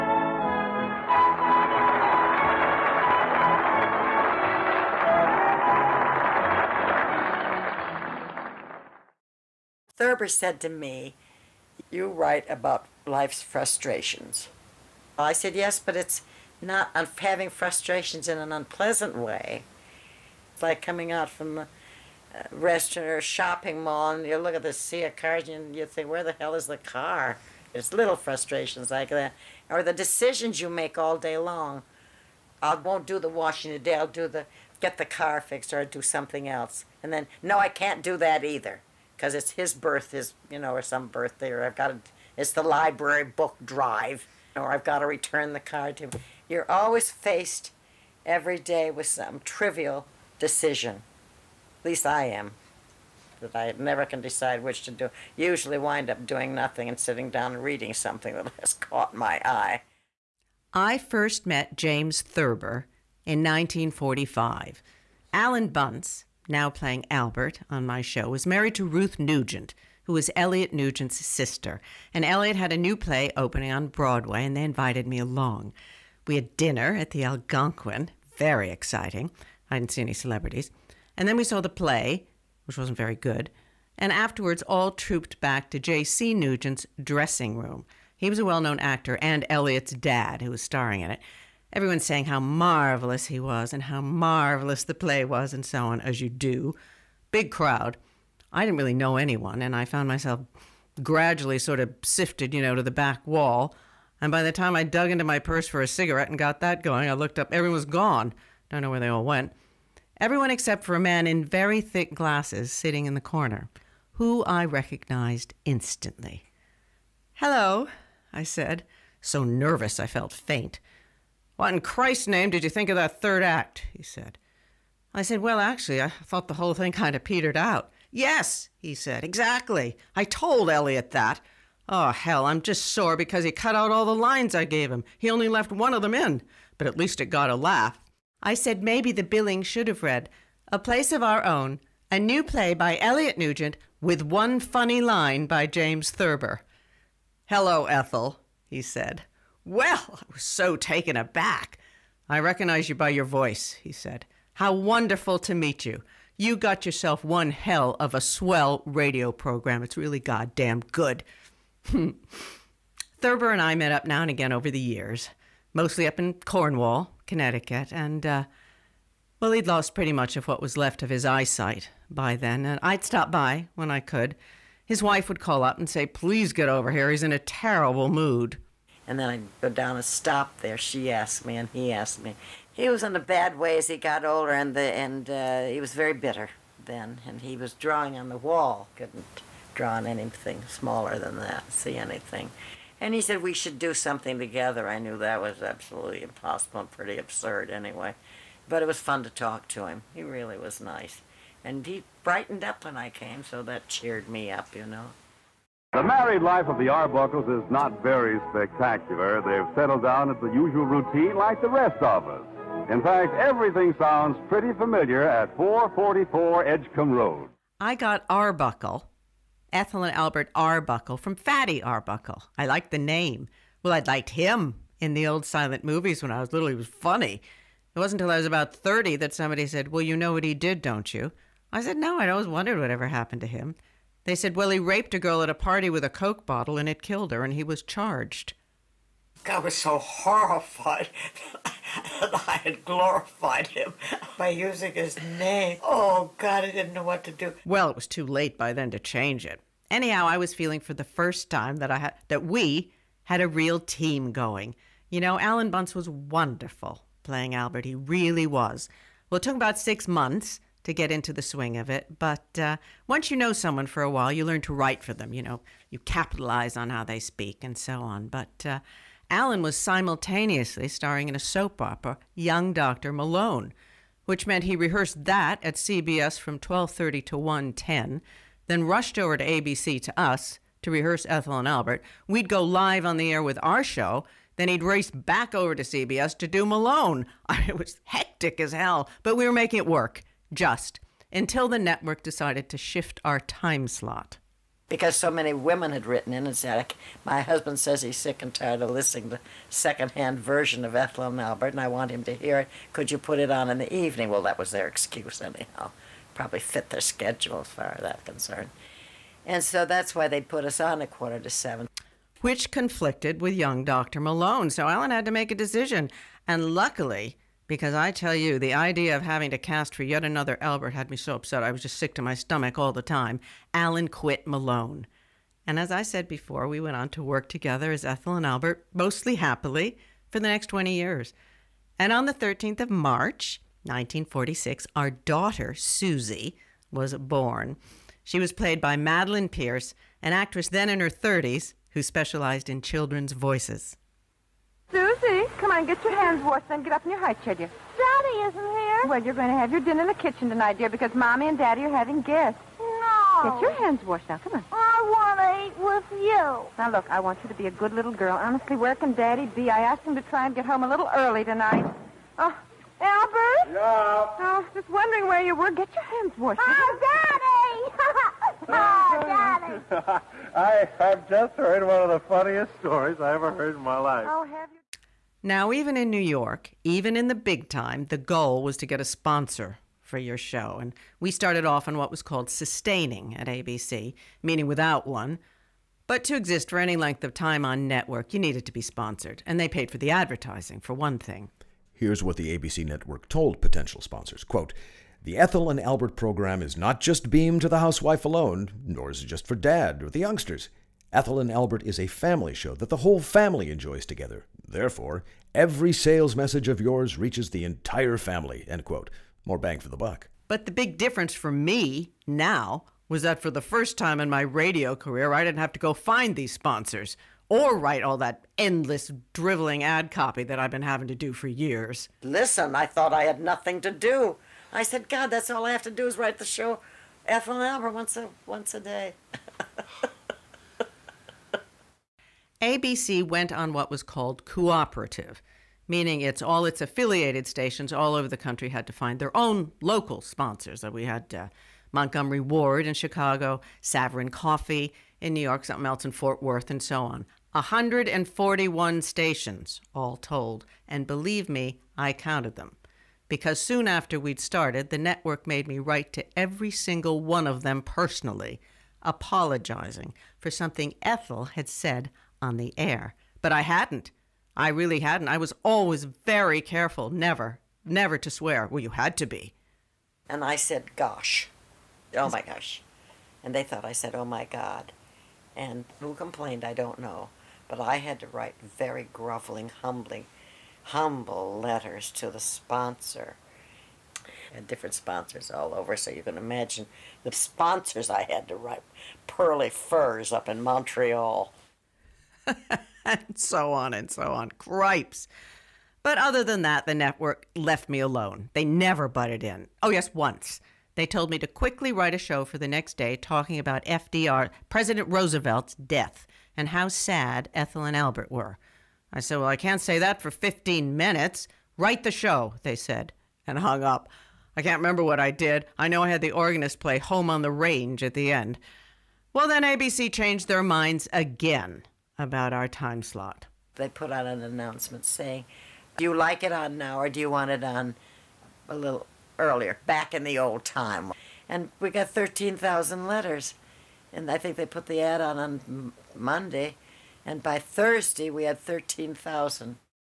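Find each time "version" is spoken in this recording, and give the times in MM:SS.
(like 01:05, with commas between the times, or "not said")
05:00.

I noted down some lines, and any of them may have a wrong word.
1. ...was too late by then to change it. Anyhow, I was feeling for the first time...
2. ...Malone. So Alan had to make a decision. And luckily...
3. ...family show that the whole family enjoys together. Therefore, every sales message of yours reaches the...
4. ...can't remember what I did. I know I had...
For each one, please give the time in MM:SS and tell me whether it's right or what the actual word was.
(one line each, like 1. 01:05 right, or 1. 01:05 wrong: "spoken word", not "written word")
1. 04:07 right
2. 05:14 right
3. 06:42 right
4. 08:34 right.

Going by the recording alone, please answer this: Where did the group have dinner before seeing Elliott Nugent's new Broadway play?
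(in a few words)
The Algonquin.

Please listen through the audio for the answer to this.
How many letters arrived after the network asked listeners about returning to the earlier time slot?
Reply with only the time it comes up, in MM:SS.
08:52.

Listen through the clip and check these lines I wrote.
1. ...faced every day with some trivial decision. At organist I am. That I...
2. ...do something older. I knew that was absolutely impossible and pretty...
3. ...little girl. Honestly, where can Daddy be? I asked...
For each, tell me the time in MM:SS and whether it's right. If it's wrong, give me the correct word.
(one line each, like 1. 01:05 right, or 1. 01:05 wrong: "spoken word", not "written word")
1. 00:47 wrong: "least", not "organist"
2. 03:13 wrong: "together", not "older"
3. 05:57 right.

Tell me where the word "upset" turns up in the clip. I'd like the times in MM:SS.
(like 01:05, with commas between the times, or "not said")
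05:21.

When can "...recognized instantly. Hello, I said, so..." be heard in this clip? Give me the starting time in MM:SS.
01:54.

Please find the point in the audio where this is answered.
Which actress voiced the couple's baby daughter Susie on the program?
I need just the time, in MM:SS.
05:38.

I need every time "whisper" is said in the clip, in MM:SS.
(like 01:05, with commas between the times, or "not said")
not said.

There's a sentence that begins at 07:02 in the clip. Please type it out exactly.
Listen, I thought I had nothing to do.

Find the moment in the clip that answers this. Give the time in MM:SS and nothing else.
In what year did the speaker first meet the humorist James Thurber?
01:03.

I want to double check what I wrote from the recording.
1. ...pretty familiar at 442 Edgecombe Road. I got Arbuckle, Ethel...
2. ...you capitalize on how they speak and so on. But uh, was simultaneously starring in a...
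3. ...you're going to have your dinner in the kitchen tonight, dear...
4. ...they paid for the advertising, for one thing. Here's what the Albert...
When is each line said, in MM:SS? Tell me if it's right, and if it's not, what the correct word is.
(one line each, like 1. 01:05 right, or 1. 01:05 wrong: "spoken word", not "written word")
1. 03:34 wrong: "444", not "442"
2. 04:25 right
3. 05:49 right
4. 06:29 wrong: "ABC", not "Albert".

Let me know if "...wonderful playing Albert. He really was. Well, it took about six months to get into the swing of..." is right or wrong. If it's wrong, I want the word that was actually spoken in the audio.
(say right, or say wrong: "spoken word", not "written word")
right.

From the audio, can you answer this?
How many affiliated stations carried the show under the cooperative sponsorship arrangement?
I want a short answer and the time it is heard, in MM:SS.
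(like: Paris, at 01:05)
141, at 07:27.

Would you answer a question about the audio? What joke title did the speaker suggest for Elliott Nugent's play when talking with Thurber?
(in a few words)
A Place of Our Own.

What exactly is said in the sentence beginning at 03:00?
She asked me, and he asked me.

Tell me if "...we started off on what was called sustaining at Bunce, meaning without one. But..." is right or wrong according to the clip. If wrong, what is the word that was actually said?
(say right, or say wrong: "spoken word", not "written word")
wrong: "ABC", not "Bunce".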